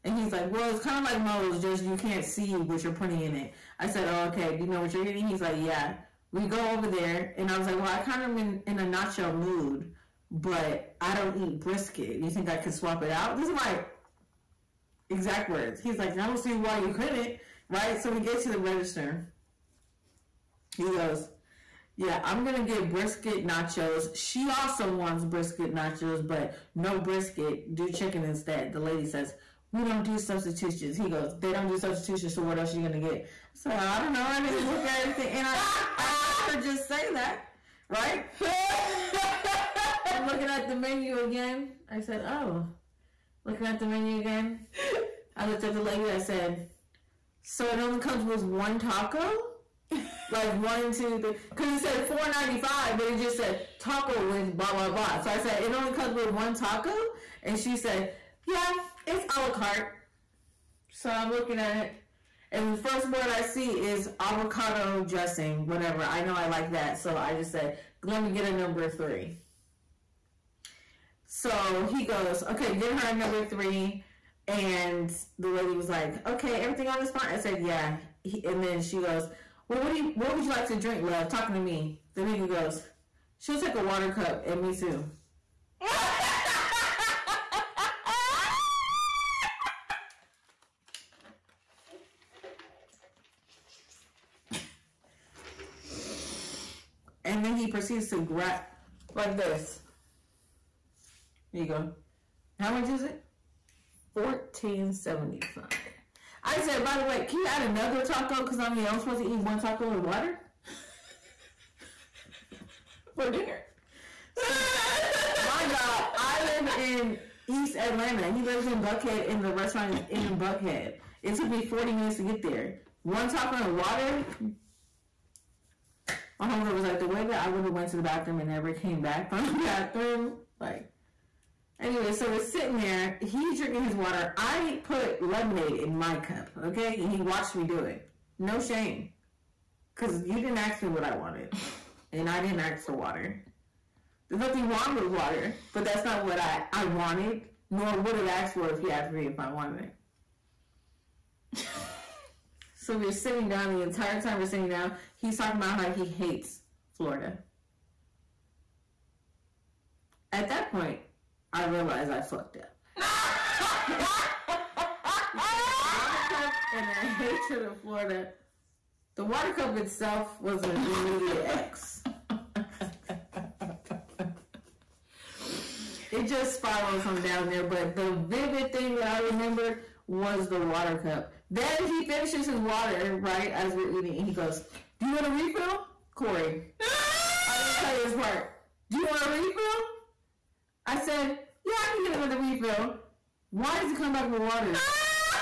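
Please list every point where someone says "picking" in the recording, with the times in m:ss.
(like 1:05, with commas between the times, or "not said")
not said.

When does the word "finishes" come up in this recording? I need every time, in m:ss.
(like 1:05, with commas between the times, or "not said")
3:02.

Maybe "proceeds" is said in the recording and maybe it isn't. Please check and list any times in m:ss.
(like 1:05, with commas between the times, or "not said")
1:37.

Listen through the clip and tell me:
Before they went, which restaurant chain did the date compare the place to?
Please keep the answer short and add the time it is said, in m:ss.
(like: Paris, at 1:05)
Moe's, at 0:01.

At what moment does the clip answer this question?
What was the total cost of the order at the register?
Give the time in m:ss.
1:44.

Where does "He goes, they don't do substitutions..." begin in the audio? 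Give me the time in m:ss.
0:30.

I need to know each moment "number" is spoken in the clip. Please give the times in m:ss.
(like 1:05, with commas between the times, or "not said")
1:08, 1:13.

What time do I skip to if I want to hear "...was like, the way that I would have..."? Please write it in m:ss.
2:06.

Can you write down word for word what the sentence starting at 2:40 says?
At that point, I realized I fucked up.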